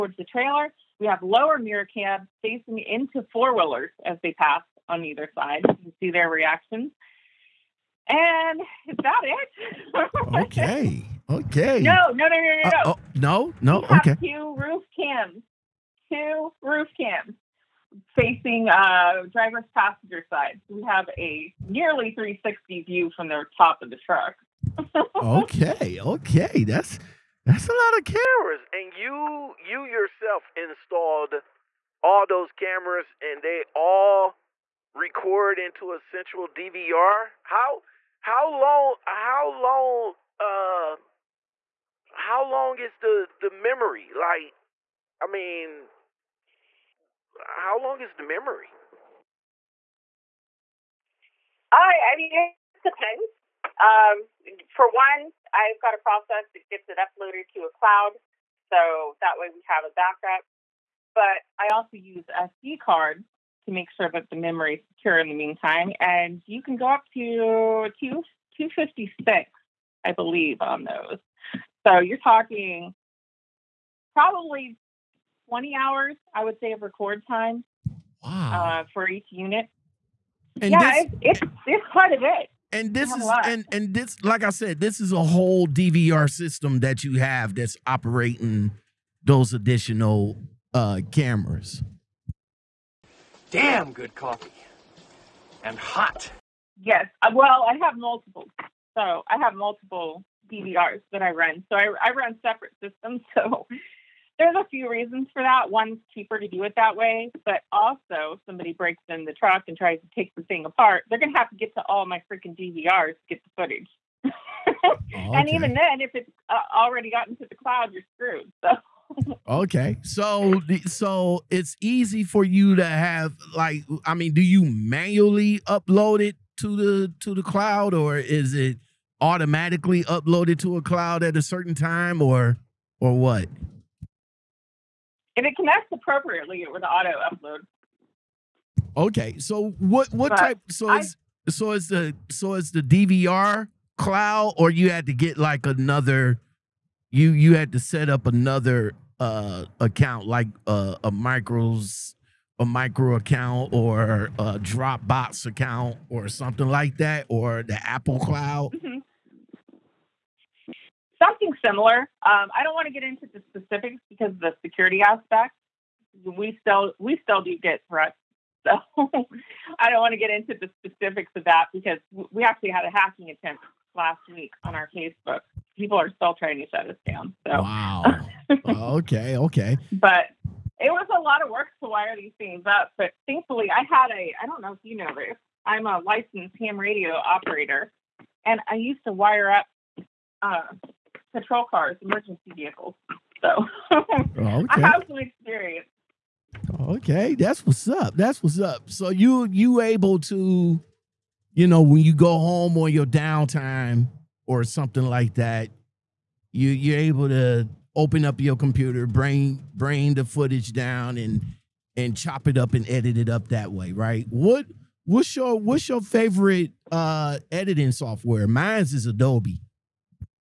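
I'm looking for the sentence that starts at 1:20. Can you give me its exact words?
And yeah, this, it's, it's, it's quite a bit.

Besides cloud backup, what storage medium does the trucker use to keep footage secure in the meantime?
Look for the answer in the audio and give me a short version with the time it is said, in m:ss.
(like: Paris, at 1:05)
SD cards, at 1:02.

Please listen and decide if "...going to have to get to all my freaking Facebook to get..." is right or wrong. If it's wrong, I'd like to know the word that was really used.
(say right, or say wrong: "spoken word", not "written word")
wrong: "DVRs", not "Facebook".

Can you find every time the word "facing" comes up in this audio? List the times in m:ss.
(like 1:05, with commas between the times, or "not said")
0:02, 0:18.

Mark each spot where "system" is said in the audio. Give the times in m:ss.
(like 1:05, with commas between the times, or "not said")
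1:26, 1:42.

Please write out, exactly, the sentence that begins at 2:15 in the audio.
If it connects appropriately, it would auto upload.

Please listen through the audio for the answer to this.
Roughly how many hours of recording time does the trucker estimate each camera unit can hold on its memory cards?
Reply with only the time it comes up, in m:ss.
1:15.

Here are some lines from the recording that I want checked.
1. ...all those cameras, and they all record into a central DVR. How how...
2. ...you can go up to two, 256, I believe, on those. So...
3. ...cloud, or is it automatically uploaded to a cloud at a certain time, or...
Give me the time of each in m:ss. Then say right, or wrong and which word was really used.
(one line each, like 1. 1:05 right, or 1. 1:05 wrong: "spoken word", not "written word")
1. 0:32 right
2. 1:06 right
3. 2:07 right.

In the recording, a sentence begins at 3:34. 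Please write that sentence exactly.
What what's your what's your favorite uh editing software?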